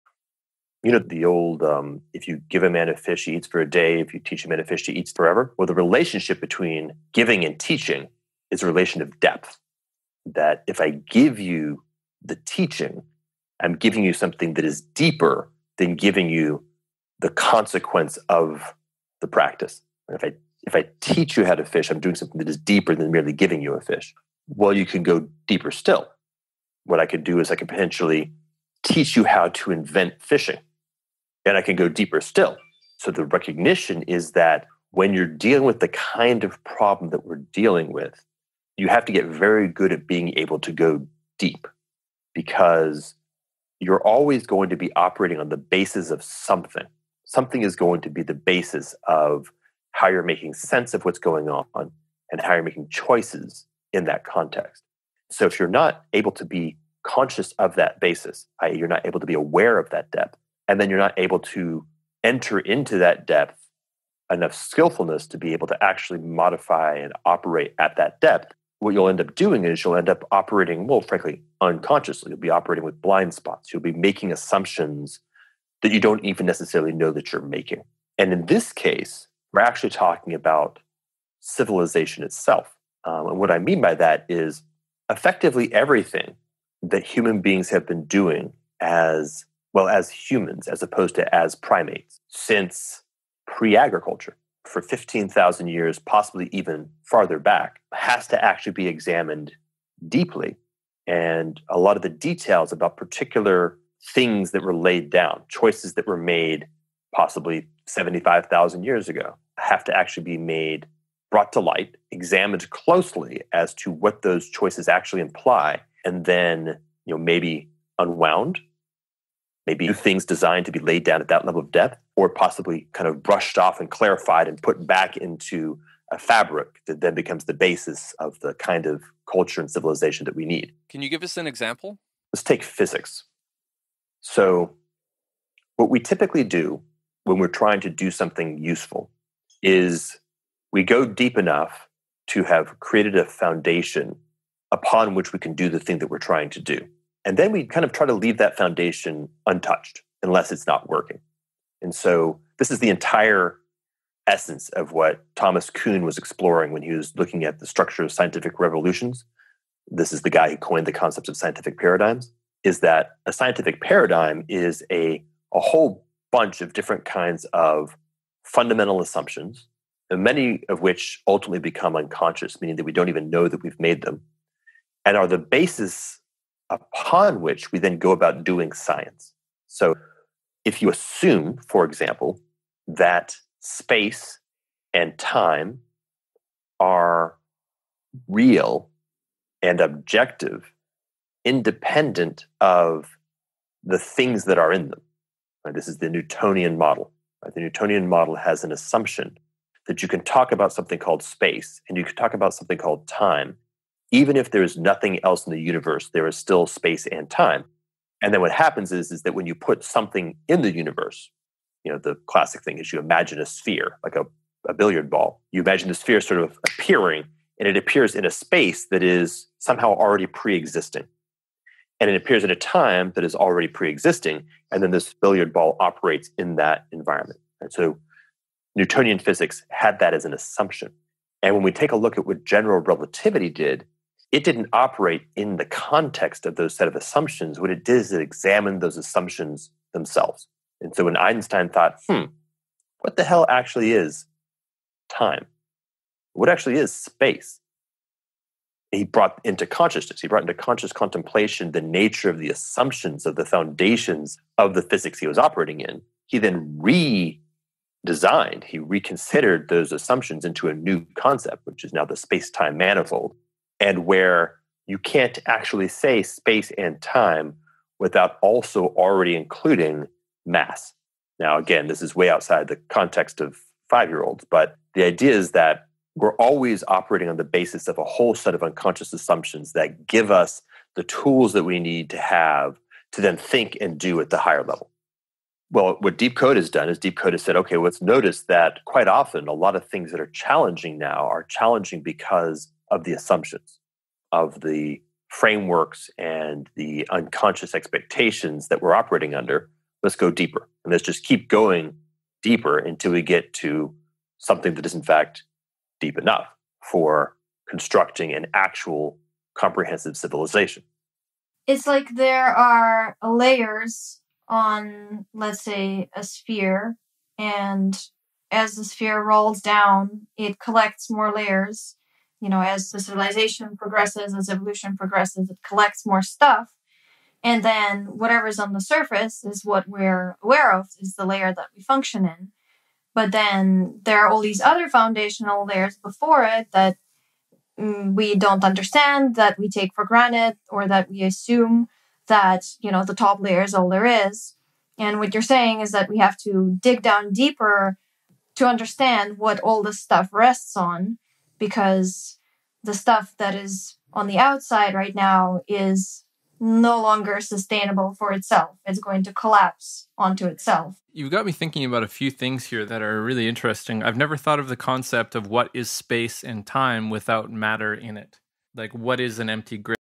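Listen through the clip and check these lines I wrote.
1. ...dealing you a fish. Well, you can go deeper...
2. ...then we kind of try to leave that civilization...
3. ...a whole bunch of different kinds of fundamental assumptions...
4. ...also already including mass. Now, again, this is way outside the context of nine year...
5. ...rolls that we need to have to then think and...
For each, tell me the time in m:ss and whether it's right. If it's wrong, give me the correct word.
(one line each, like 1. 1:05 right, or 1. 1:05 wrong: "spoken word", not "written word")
1. 0:23 wrong: "giving", not "dealing"
2. 2:27 wrong: "foundation", not "civilization"
3. 2:45 right
4. 4:28 wrong: "five", not "nine"
5. 4:41 wrong: "tools", not "rolls".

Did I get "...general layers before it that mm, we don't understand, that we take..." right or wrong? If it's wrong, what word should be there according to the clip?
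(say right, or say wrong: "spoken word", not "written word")
wrong: "foundational", not "general".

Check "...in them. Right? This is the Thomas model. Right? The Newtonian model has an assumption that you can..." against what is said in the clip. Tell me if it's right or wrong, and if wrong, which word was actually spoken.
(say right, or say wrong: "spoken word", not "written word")
wrong: "Newtonian", not "Thomas".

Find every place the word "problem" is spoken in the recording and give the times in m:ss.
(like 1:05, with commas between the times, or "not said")
0:36.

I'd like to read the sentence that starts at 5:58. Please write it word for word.
It's going to collapse onto itself.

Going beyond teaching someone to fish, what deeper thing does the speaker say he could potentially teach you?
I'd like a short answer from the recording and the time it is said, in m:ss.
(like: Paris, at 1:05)
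How to invent fishing, at 0:29.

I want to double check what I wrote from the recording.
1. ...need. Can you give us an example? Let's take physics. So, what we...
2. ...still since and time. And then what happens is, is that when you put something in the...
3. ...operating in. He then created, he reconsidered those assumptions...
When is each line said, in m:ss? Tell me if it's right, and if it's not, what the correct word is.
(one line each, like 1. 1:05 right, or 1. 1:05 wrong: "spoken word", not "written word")
1. 2:10 right
2. 3:26 wrong: "space", not "since"
3. 4:15 wrong: "redesigned", not "created".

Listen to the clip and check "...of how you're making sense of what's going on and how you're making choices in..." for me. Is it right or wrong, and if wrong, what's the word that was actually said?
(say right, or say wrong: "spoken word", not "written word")
right.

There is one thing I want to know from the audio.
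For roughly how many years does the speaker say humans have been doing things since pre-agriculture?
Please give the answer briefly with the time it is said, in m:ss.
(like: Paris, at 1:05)
15,000 years, at 1:34.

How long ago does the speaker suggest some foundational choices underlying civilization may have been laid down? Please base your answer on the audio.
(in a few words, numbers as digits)
75,000 years ago.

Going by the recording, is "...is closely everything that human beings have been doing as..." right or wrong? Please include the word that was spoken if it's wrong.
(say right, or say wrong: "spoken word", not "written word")
wrong: "effectively", not "closely".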